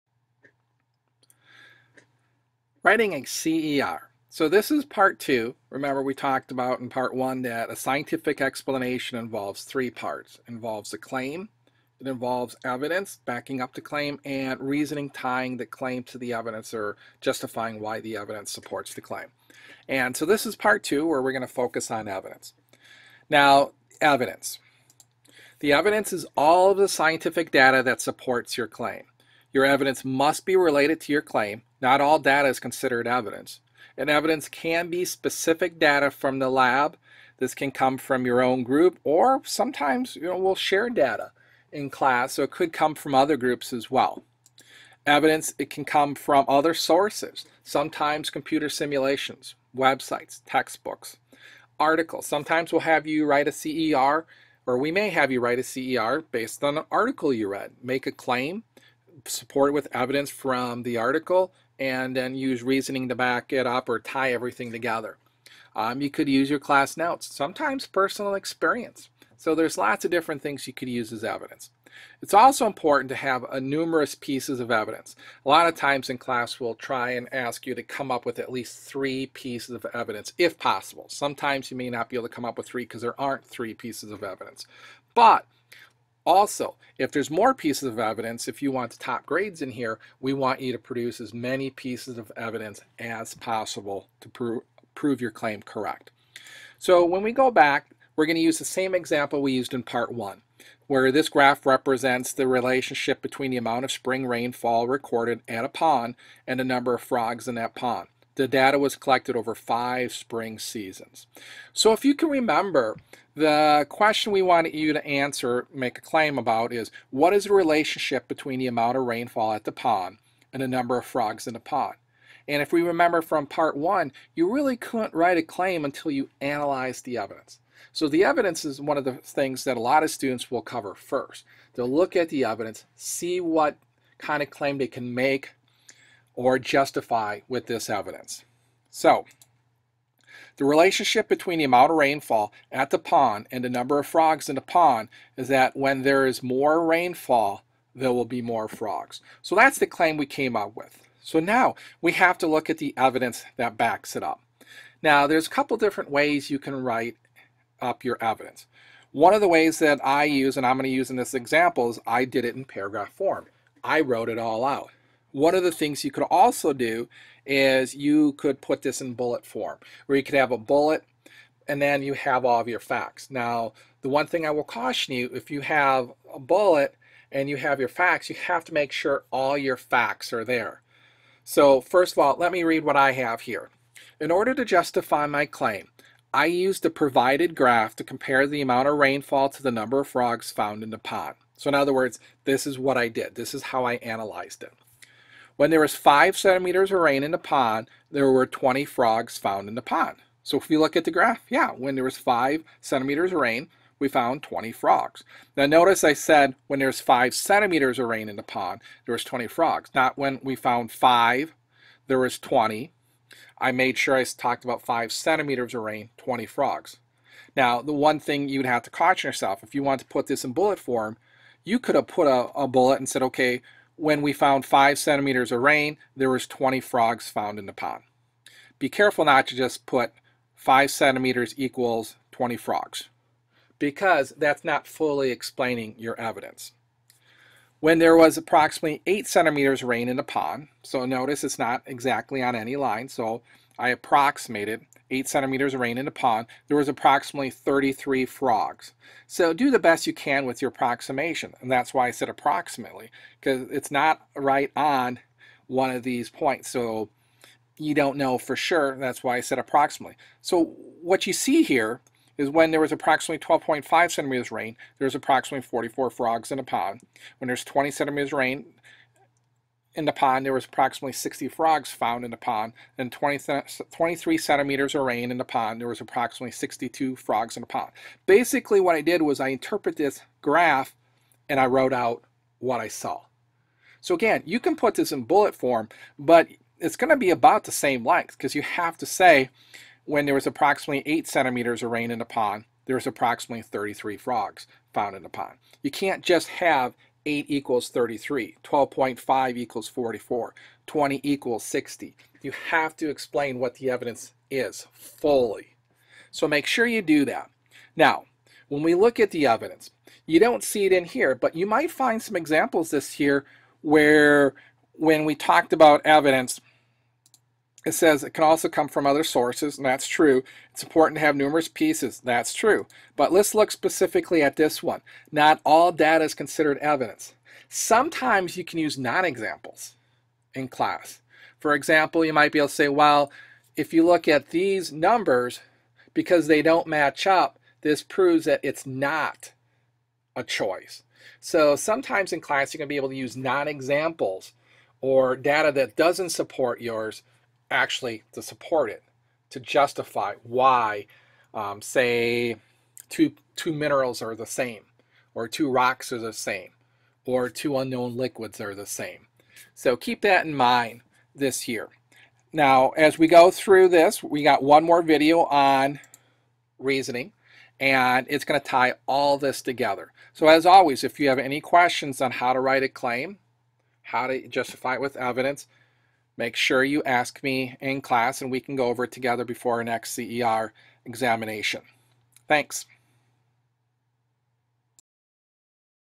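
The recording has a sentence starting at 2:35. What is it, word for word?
Now there's a couple different ways you can write up your evidence.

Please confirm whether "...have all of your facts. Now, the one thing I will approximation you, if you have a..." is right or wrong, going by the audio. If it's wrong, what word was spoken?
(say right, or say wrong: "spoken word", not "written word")
wrong: "caution", not "approximation".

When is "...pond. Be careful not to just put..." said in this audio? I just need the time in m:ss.
3:47.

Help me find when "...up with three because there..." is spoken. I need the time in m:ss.
1:22.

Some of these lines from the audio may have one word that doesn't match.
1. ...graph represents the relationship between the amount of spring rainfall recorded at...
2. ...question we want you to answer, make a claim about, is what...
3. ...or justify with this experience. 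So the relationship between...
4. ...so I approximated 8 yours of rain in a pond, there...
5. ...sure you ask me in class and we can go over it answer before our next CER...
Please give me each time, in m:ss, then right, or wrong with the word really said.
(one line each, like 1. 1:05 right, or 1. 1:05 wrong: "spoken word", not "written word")
1. 1:41 right
2. 1:53 right
3. 2:16 wrong: "evidence", not "experience"
4. 4:03 wrong: "centimeters", not "yours"
5. 6:16 wrong: "together", not "answer".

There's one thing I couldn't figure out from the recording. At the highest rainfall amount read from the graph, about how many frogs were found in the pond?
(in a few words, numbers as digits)
62.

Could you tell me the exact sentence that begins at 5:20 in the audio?
It's important to have numerous pieces, that's true.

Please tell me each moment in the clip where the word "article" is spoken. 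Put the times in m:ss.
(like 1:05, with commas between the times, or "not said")
0:51, 0:56, 1:00.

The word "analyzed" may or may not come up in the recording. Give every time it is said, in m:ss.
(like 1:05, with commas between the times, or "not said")
2:06, 3:13.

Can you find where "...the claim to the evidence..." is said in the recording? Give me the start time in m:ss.
0:15.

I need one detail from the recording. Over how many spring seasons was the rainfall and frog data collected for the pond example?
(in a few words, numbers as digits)
5.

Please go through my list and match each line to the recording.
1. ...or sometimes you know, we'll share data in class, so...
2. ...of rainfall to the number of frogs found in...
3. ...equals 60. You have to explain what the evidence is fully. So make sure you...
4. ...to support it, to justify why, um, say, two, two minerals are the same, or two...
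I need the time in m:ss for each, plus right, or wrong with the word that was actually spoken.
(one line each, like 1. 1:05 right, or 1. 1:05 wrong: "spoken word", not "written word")
1. 0:39 right
2. 3:08 right
3. 5:01 right
4. 5:48 right.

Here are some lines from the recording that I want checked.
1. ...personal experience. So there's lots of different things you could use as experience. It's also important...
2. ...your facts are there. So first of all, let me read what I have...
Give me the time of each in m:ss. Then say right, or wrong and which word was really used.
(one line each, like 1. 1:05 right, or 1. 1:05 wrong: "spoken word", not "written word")
1. 1:07 wrong: "evidence", not "experience"
2. 2:59 right.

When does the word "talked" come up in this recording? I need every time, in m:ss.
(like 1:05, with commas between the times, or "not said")
0:06, 3:34, 5:15.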